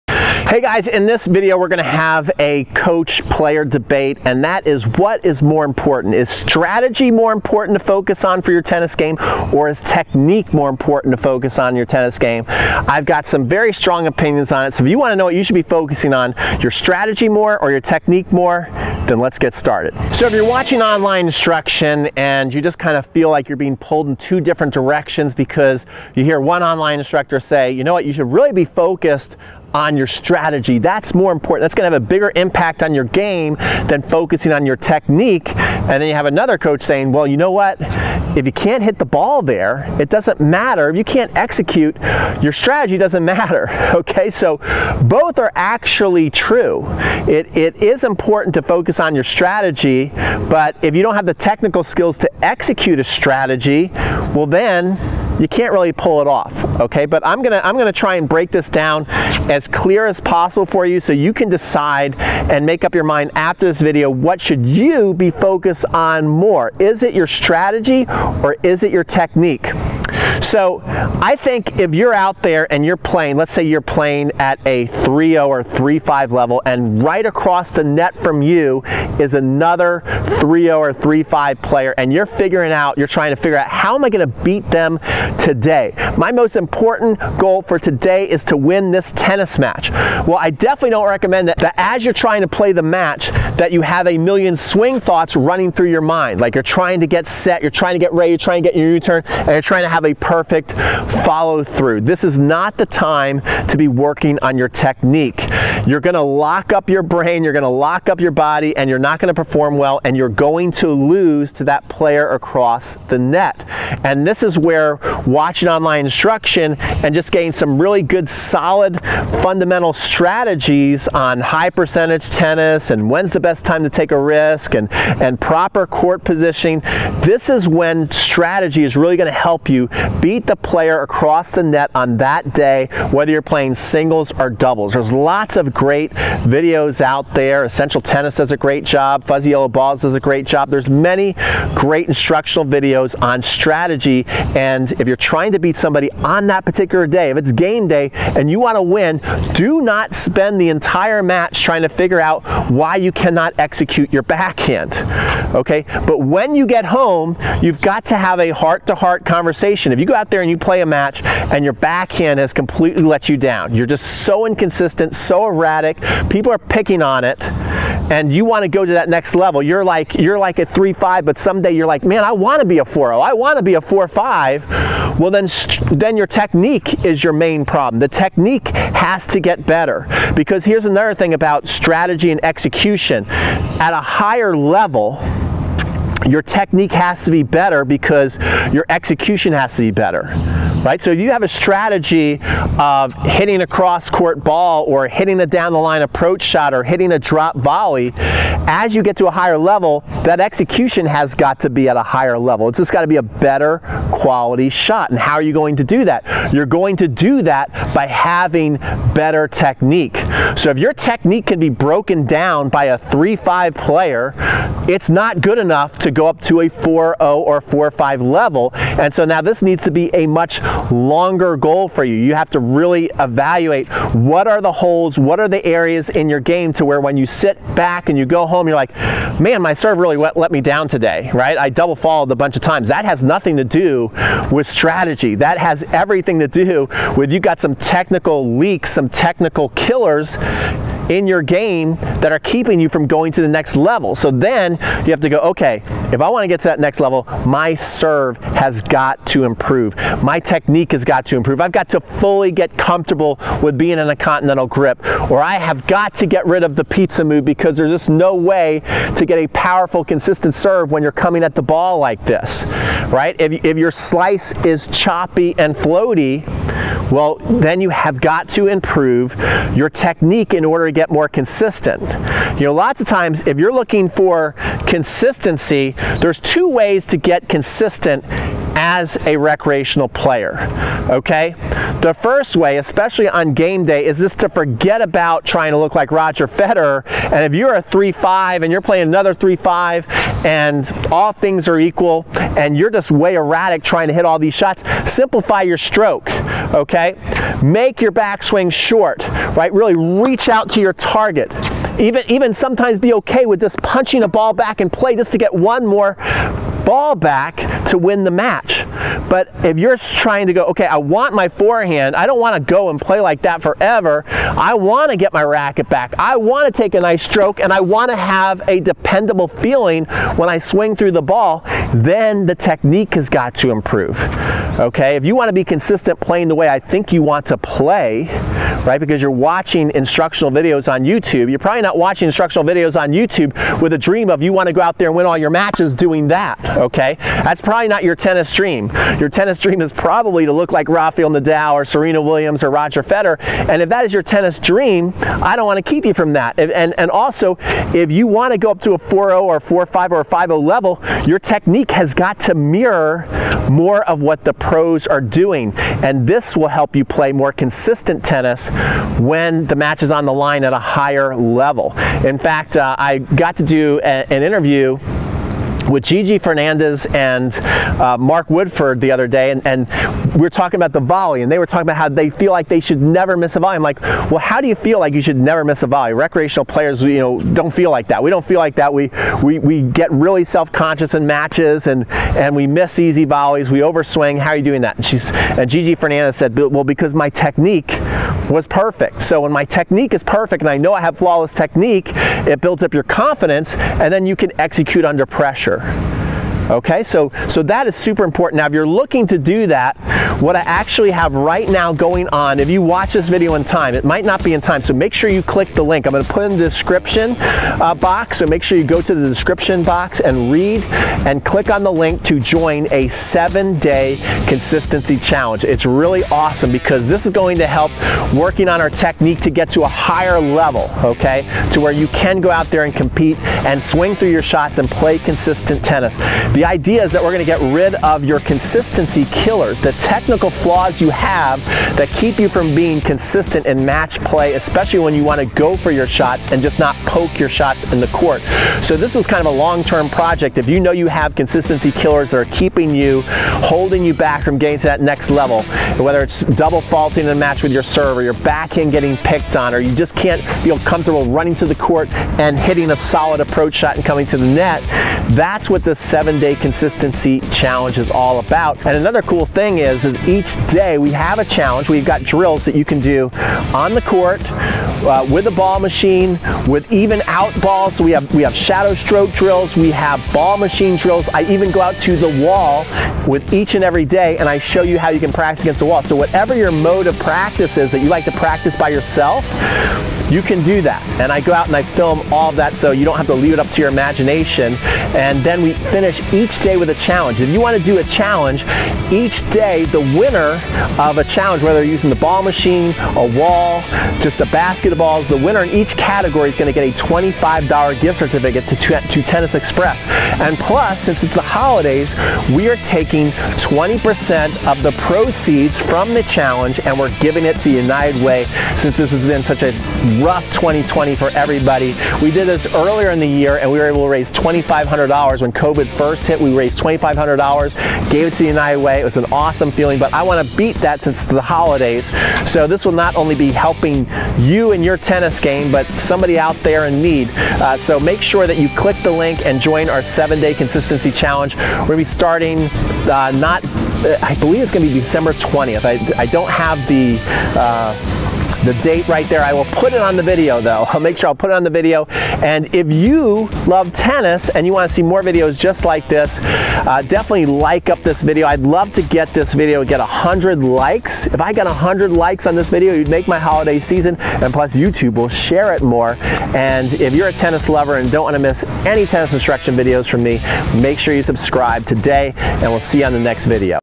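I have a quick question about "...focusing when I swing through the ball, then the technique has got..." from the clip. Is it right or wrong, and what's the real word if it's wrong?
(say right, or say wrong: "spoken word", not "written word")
wrong: "feeling", not "focusing".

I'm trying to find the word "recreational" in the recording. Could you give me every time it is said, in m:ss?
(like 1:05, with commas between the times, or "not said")
4:39, 6:16.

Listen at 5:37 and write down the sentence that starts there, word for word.
That's probably not your tennis dream dream.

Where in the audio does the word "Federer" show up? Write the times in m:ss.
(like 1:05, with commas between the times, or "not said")
4:46, 5:43.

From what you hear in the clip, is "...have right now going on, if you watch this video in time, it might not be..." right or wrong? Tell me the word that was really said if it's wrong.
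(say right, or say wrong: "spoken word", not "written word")
right.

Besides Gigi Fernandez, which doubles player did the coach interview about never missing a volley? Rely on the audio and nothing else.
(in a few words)
Mark Woodforde.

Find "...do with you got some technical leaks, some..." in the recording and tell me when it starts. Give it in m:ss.
3:56.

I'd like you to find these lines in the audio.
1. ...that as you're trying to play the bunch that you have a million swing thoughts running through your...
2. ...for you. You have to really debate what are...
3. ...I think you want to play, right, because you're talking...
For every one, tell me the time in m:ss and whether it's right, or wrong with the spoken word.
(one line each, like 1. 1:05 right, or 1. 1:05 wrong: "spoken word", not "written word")
1. 1:31 wrong: "match", not "bunch"
2. 3:41 wrong: "evaluate", not "debate"
3. 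5:26 wrong: "watching", not "talking".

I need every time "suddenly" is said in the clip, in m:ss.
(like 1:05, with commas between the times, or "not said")
not said.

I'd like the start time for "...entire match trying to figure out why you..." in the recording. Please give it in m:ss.
2:30.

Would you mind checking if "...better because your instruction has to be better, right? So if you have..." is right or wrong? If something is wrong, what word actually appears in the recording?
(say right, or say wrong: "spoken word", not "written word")
wrong: "execution", not "instruction".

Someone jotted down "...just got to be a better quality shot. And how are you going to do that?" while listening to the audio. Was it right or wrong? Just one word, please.
right.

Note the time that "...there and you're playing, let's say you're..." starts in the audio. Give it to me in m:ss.
1:12.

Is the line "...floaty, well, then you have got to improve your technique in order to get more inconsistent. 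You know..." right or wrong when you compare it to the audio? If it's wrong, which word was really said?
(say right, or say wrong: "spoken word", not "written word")
wrong: "consistent", not "inconsistent".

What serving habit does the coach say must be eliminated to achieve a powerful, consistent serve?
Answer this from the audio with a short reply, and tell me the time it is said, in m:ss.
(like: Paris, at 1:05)
the pizza move, at 4:16.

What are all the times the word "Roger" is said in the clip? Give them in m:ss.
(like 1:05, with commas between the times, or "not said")
4:46, 5:42.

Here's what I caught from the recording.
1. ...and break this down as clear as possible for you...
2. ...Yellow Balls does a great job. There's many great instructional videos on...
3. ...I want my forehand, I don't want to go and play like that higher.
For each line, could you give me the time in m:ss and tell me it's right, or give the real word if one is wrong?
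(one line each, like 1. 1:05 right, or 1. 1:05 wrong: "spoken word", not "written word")
1. 0:58 right
2. 2:19 right
3. 5:10 wrong: "forever", not "higher".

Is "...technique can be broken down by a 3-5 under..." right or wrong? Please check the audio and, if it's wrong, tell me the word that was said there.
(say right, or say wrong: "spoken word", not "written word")
wrong: "player", not "under".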